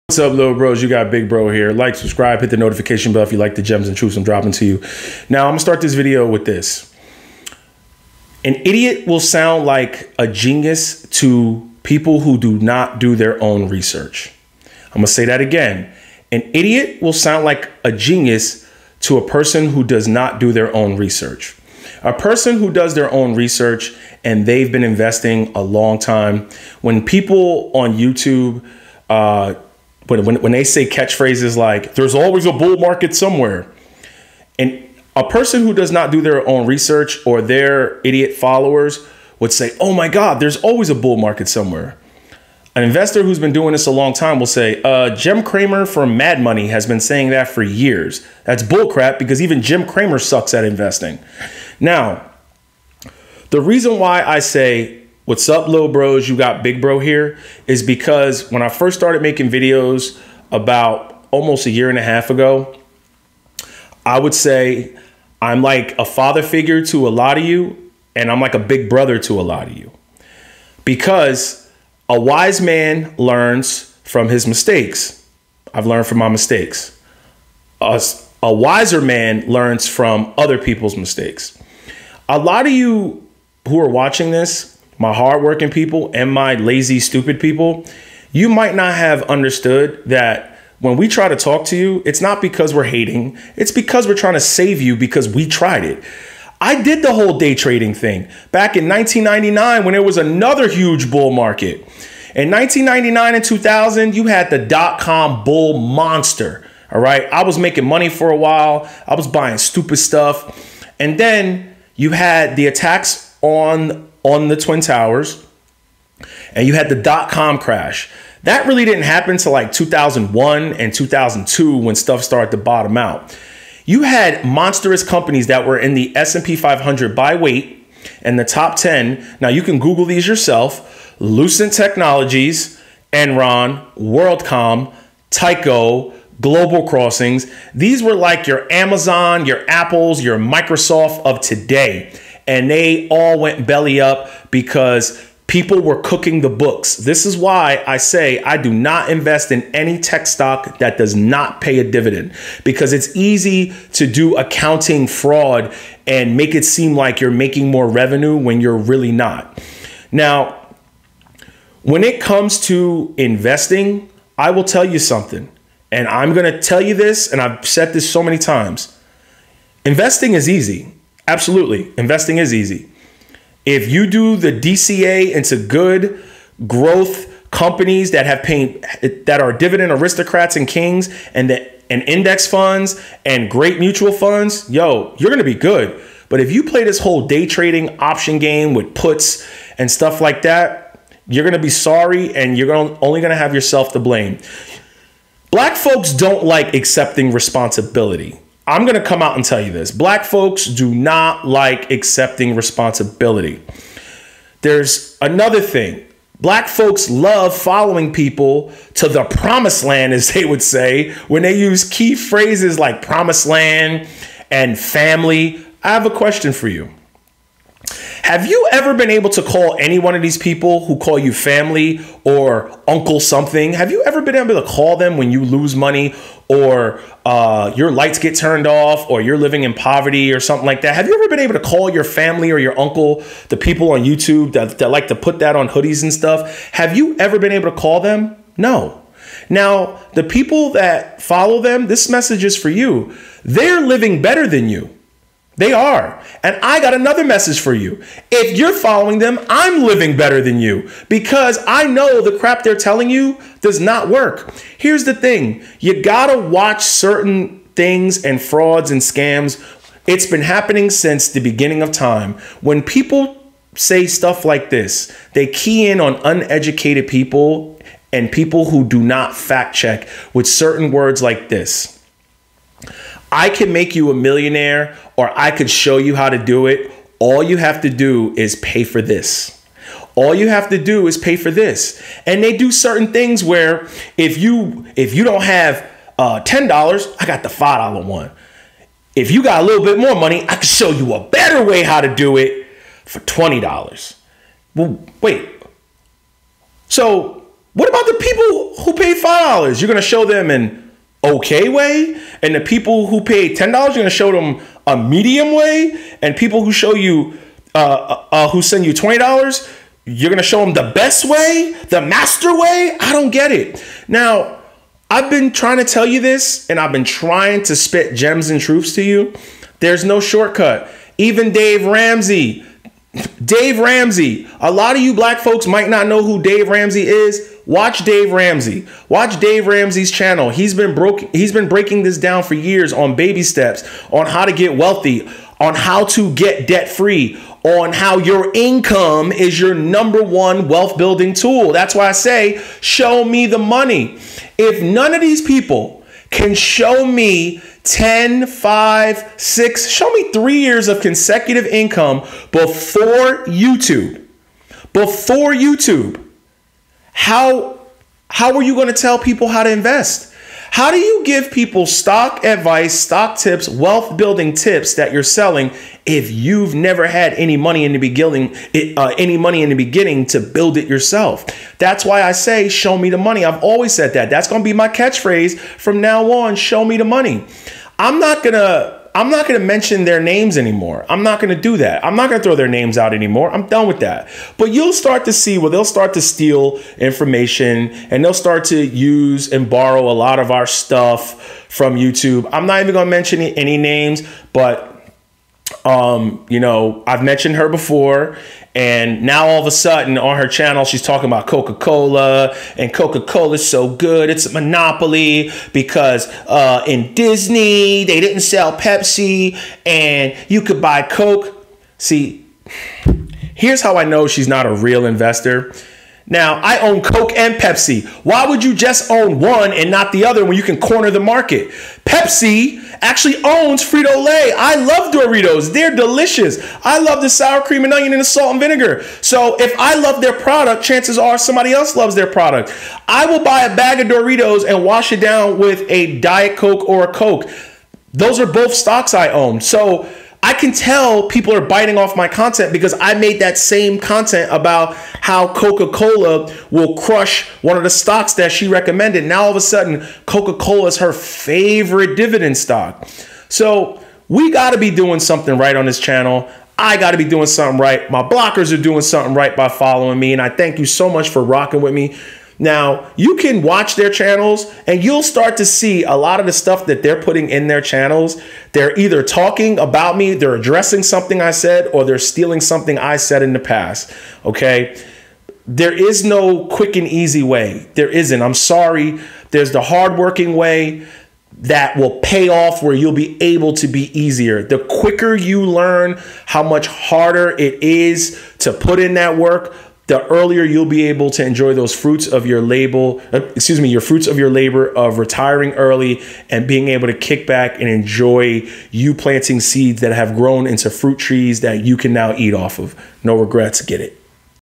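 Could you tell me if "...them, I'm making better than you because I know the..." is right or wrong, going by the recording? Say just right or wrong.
wrong.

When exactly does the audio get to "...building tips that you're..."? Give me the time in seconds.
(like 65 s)
364 s.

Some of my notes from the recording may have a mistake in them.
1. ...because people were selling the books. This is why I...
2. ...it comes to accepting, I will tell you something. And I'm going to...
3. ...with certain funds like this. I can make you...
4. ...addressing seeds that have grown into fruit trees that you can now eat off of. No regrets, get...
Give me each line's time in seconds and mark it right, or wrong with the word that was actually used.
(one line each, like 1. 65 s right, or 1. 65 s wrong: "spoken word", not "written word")
1. 144 s wrong: "cooking", not "selling"
2. 162 s wrong: "investing", not "accepting"
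3. 270 s wrong: "words", not "funds"
4. 499 s wrong: "planting", not "addressing".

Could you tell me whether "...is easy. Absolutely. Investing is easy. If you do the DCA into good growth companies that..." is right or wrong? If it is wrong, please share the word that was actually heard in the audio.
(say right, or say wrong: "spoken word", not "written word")
right.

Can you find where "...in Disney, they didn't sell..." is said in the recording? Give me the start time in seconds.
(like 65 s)
406 s.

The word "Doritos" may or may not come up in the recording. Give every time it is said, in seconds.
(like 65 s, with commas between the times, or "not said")
425 s, 434 s.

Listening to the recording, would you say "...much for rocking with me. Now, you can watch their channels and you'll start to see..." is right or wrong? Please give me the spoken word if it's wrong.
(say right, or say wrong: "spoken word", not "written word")
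right.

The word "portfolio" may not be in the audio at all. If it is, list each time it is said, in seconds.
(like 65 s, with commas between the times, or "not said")
not said.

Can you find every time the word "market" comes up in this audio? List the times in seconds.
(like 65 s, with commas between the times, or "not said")
32 s, 41 s, 101 s, 421 s.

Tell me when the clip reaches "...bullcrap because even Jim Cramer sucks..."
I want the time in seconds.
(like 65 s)
48 s.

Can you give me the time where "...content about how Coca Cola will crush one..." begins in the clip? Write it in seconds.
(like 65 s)
443 s.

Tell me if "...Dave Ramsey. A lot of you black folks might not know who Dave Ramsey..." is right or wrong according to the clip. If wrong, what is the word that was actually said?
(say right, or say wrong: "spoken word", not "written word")
right.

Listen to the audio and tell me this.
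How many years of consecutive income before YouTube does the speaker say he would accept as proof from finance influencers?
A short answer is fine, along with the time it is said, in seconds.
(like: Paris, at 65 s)
3, at 350 s.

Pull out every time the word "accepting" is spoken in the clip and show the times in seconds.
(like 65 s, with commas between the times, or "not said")
196 s, 201 s.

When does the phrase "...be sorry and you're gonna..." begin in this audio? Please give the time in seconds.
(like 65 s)
191 s.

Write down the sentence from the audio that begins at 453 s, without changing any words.
So we got to be doing something right on this channel.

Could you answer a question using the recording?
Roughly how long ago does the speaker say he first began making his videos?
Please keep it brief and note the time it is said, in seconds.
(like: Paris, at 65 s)
a year and a half, at 61 s.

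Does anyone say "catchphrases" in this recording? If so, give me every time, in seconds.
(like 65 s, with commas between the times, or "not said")
30 s, 374 s.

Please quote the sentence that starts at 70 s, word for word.
Because a wise man learns from his mistakes.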